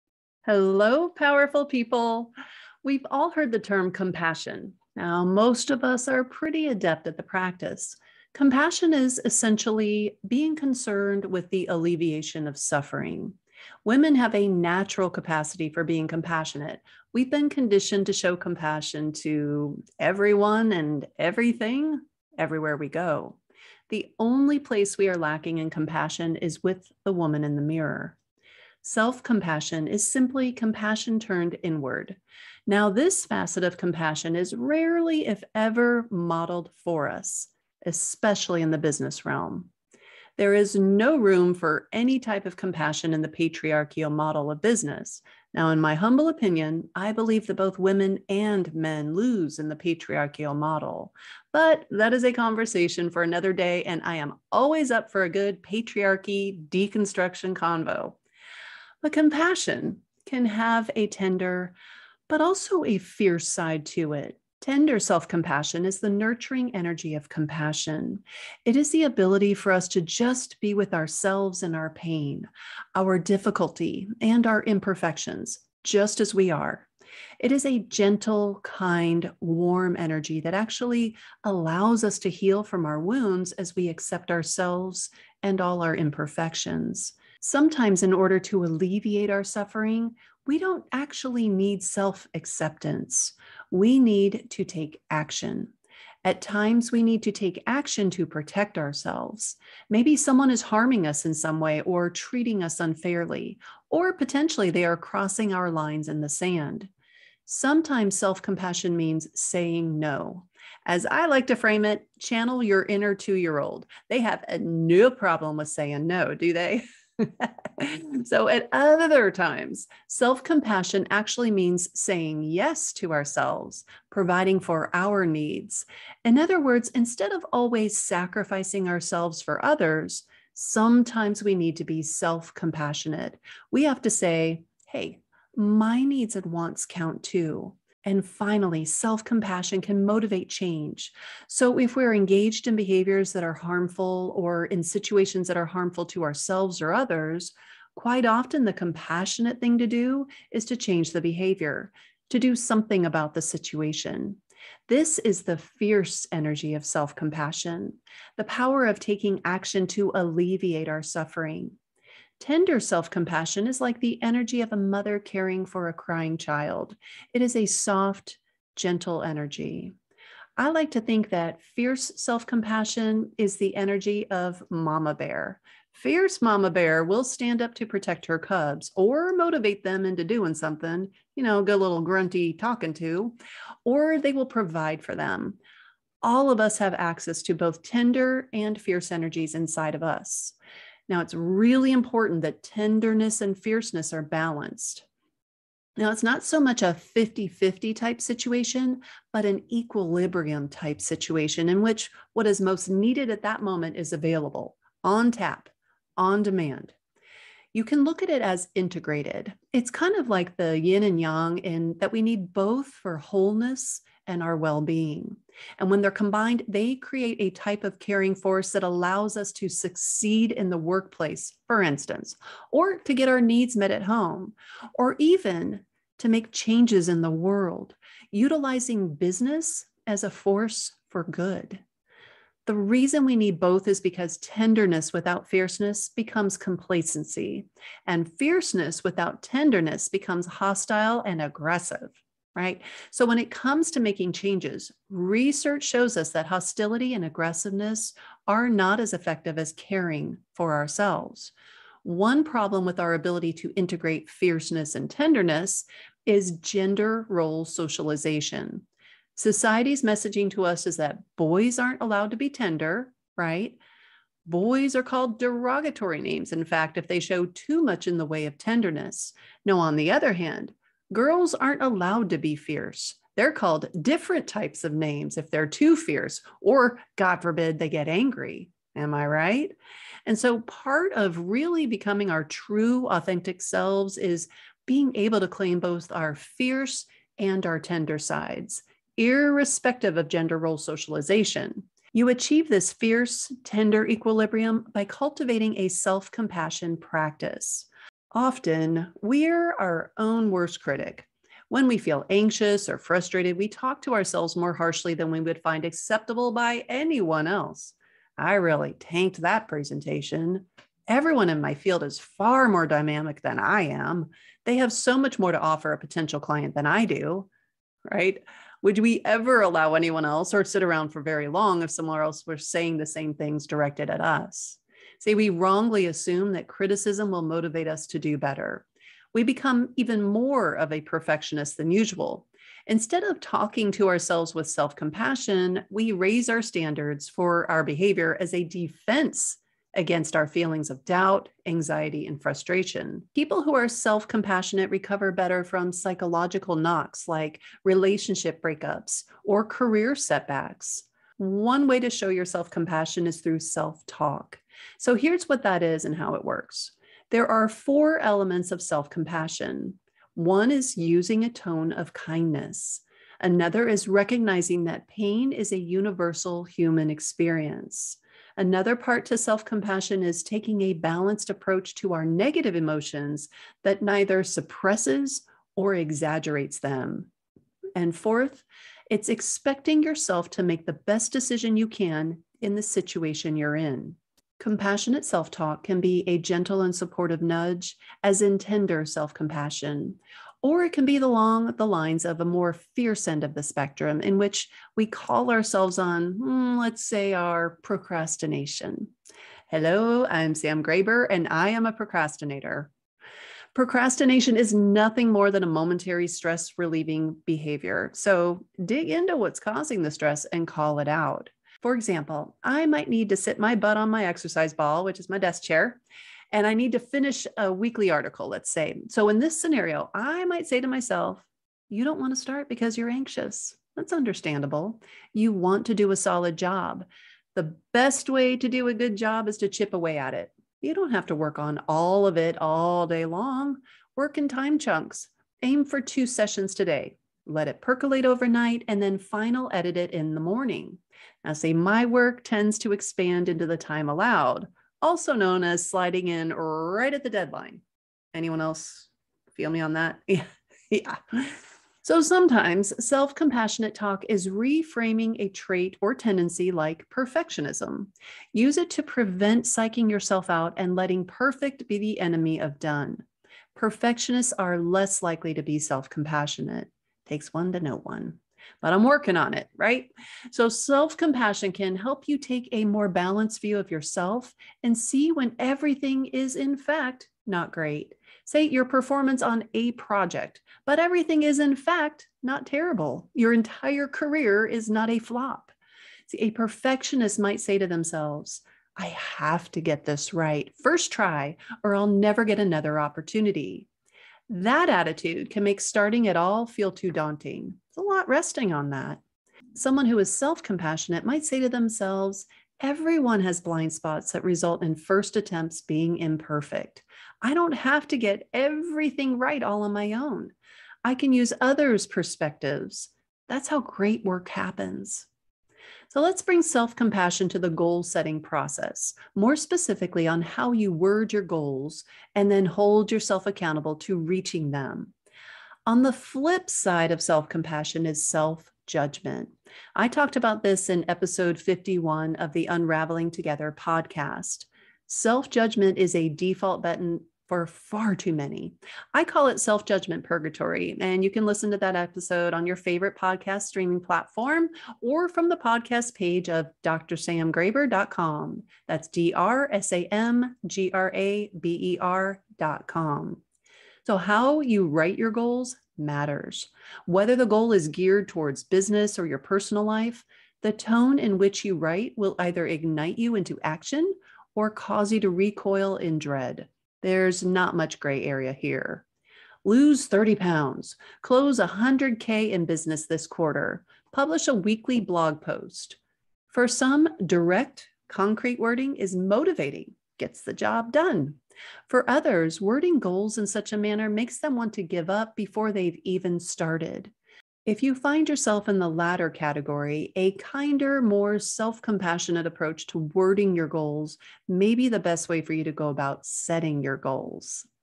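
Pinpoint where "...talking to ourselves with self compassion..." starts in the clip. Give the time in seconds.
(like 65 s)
333 s.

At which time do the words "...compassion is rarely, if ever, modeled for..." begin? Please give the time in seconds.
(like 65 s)
33 s.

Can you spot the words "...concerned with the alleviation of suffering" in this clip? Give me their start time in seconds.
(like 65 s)
10 s.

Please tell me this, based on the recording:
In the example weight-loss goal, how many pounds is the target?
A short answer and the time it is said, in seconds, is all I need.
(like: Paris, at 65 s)
30, at 570 s.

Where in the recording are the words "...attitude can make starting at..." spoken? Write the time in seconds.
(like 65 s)
494 s.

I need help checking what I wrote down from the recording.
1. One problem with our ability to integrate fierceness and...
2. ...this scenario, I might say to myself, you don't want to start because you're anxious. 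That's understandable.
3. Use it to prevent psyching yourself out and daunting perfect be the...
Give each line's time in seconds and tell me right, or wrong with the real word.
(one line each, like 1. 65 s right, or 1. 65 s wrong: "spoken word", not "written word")
1. 252 s right
2. 419 s right
3. 458 s wrong: "letting", not "daunting".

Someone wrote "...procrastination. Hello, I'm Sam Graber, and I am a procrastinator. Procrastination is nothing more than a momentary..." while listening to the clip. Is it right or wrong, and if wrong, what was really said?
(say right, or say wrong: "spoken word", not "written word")
right.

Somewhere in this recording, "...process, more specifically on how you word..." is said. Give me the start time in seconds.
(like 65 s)
518 s.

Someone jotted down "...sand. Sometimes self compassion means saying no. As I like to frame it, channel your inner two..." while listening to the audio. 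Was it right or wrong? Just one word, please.
right.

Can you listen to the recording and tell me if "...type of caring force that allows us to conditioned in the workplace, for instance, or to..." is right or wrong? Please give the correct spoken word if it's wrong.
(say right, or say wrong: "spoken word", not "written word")
wrong: "succeed", not "conditioned".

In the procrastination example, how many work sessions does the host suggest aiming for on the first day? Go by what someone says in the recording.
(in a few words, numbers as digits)
2.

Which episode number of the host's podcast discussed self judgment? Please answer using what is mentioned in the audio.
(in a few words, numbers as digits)
51.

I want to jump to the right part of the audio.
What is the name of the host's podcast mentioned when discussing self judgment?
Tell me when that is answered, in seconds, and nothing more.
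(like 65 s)
532 s.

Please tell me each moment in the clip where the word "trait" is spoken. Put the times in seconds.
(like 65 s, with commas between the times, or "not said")
455 s.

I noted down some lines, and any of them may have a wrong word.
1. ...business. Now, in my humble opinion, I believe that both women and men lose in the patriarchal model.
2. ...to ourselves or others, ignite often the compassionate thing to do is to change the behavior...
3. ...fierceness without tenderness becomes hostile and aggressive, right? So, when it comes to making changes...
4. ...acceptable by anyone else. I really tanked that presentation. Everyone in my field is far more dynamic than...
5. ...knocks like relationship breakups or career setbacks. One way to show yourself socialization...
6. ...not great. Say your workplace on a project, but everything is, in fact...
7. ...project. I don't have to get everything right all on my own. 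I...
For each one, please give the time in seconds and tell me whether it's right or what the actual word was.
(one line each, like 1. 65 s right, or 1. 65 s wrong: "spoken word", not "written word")
1. 44 s right
2. 146 s wrong: "quite", not "ignite"
3. 238 s right
4. 305 s right
5. 346 s wrong: "compassion", not "socialization"
6. 477 s wrong: "performance", not "workplace"
7. 506 s wrong: "imperfect", not "project".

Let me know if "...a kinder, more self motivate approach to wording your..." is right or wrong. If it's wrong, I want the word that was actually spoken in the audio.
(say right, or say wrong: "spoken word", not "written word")
wrong: "compassionate", not "motivate".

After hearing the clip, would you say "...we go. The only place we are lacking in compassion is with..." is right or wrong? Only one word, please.
right.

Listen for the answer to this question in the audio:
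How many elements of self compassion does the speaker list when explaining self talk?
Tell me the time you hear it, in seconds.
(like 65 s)
357 s.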